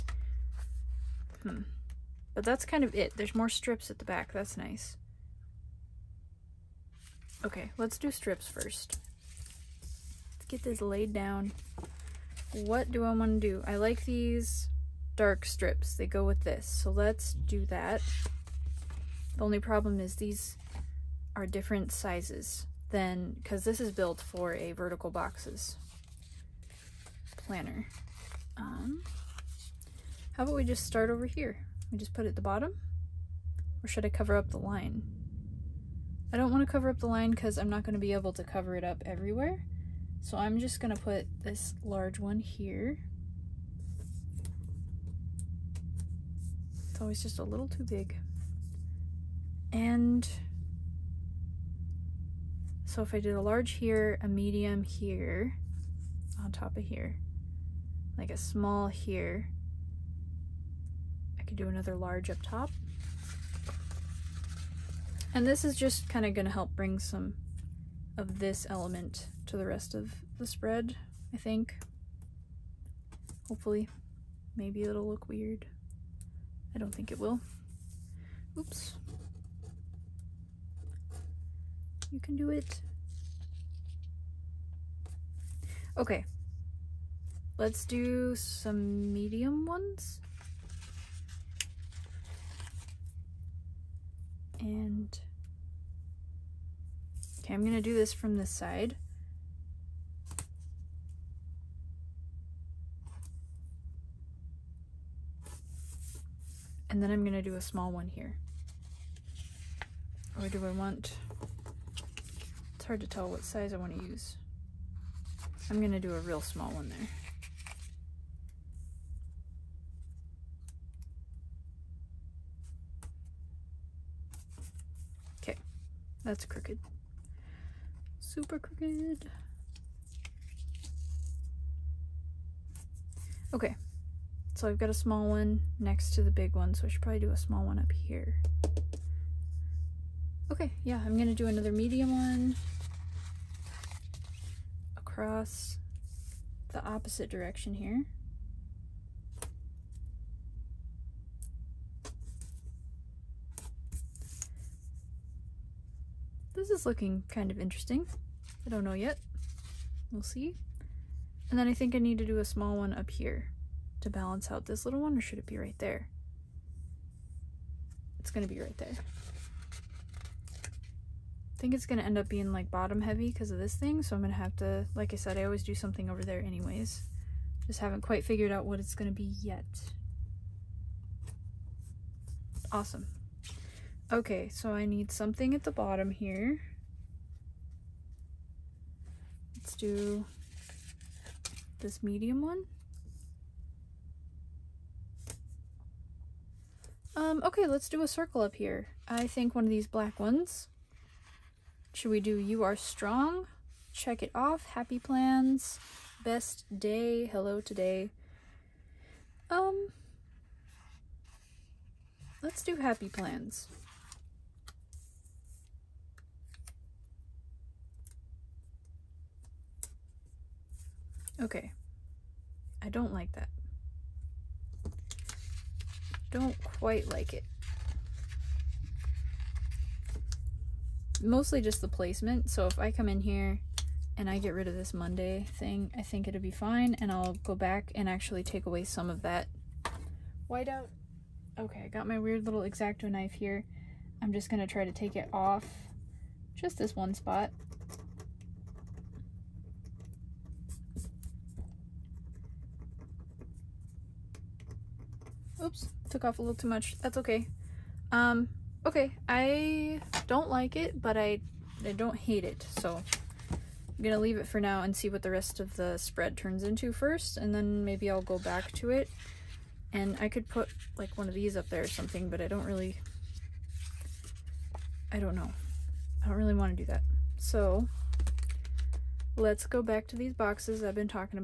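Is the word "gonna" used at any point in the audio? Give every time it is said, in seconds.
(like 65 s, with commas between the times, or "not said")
97 s, 107 s, 115 s, 141 s, 264 s.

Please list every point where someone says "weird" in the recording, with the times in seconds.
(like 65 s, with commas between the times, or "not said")
75 s, 242 s.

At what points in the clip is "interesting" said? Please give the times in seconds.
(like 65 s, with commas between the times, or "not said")
157 s.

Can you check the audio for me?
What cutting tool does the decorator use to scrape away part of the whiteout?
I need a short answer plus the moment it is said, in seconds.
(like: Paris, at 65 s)
X-Acto knife, at 242 s.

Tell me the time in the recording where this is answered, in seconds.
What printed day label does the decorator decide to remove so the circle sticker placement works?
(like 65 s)
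234 s.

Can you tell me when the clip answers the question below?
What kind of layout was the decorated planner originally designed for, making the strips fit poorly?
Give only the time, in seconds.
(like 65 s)
24 s.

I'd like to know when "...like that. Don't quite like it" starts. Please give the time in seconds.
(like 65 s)
223 s.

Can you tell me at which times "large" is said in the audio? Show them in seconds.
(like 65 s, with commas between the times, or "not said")
41 s, 53 s, 61 s.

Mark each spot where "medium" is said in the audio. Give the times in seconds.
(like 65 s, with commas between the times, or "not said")
54 s, 89 s, 141 s, 192 s.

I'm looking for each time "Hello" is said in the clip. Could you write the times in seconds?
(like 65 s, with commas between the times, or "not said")
207 s.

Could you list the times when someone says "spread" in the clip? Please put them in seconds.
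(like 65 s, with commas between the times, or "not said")
70 s, 265 s.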